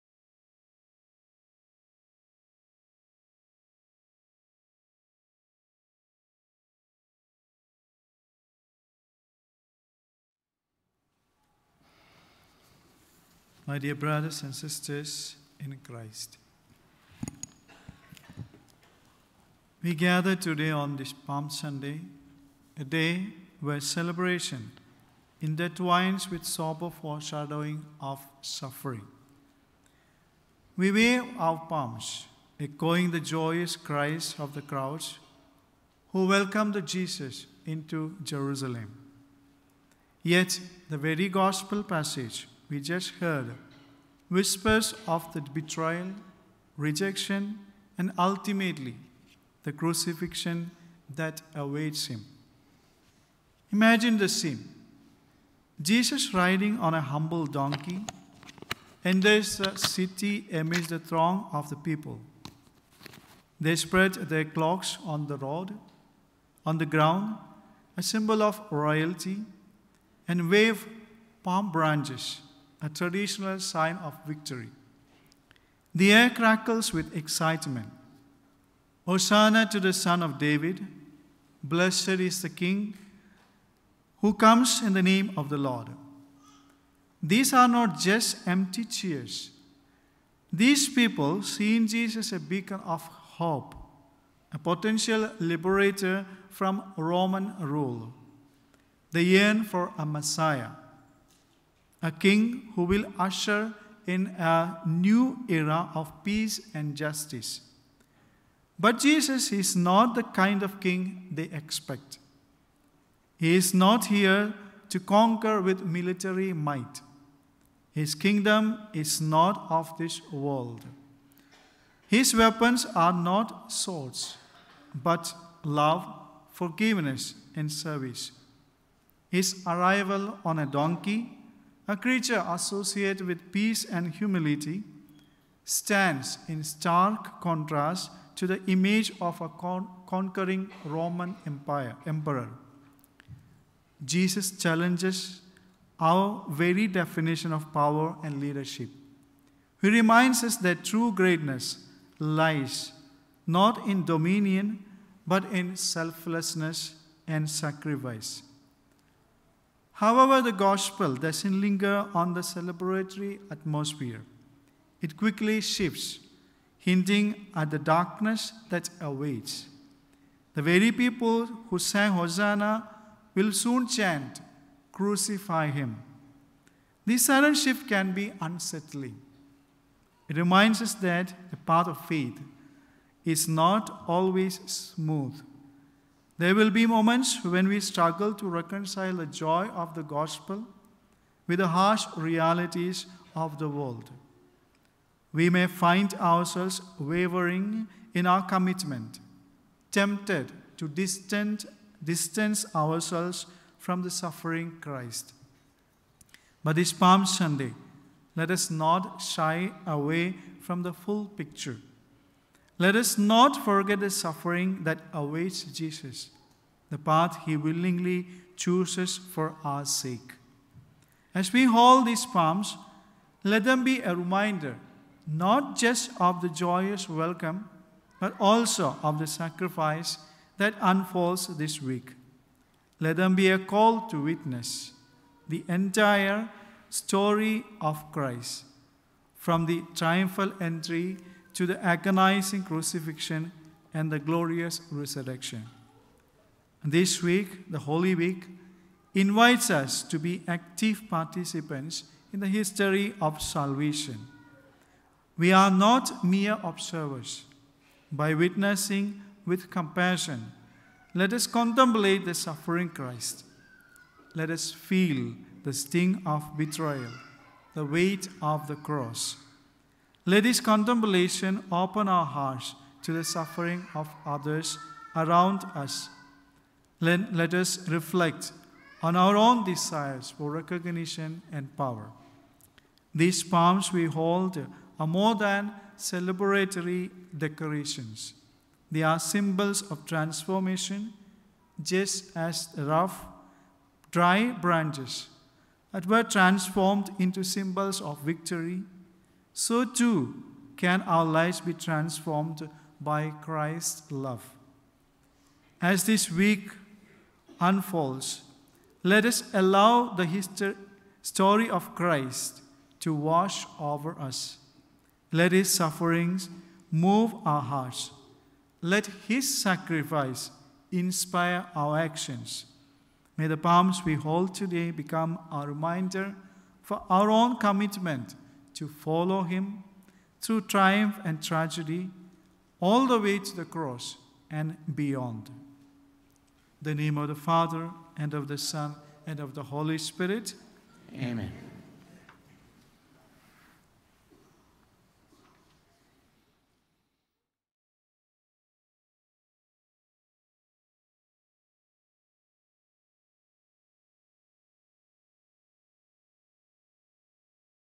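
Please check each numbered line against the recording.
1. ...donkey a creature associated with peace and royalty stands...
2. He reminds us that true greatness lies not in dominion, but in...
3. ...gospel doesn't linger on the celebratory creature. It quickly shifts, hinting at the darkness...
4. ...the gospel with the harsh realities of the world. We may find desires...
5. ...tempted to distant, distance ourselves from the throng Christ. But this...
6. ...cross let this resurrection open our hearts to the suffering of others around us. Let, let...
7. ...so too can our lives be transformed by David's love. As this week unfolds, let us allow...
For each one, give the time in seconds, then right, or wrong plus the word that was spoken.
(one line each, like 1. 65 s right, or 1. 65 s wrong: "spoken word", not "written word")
1. 130 s wrong: "humility", not "royalty"
2. 149 s right
3. 160 s wrong: "atmosphere", not "creature"
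4. 189 s wrong: "ourselves", not "desires"
5. 199 s wrong: "suffering", not "throng"
6. 268 s wrong: "contemplation", not "resurrection"
7. 299 s wrong: "Christ", not "David".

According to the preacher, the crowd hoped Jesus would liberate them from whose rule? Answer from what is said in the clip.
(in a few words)
Roman rule.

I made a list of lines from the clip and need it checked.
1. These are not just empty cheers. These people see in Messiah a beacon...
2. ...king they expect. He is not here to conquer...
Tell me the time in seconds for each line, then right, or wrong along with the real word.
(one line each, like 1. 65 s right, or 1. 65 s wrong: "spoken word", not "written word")
1. 87 s wrong: "Jesus", not "Messiah"
2. 110 s right.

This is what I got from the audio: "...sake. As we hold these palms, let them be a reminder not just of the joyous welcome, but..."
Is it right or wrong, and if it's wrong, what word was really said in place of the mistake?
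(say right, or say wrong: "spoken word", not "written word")
right.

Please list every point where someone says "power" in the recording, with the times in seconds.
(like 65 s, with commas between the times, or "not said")
147 s, 281 s.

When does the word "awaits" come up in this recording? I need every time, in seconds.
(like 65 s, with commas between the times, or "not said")
51 s, 168 s, 215 s.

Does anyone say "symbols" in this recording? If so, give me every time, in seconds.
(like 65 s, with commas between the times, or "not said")
68 s, 289 s, 297 s.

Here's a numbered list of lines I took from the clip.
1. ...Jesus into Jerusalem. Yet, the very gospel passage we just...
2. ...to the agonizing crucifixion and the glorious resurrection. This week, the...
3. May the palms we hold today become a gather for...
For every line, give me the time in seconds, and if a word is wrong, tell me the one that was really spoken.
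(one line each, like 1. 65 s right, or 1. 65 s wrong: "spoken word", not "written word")
1. 36 s right
2. 241 s right
3. 323 s wrong: "reminder", not "gather".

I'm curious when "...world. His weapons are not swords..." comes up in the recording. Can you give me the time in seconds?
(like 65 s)
120 s.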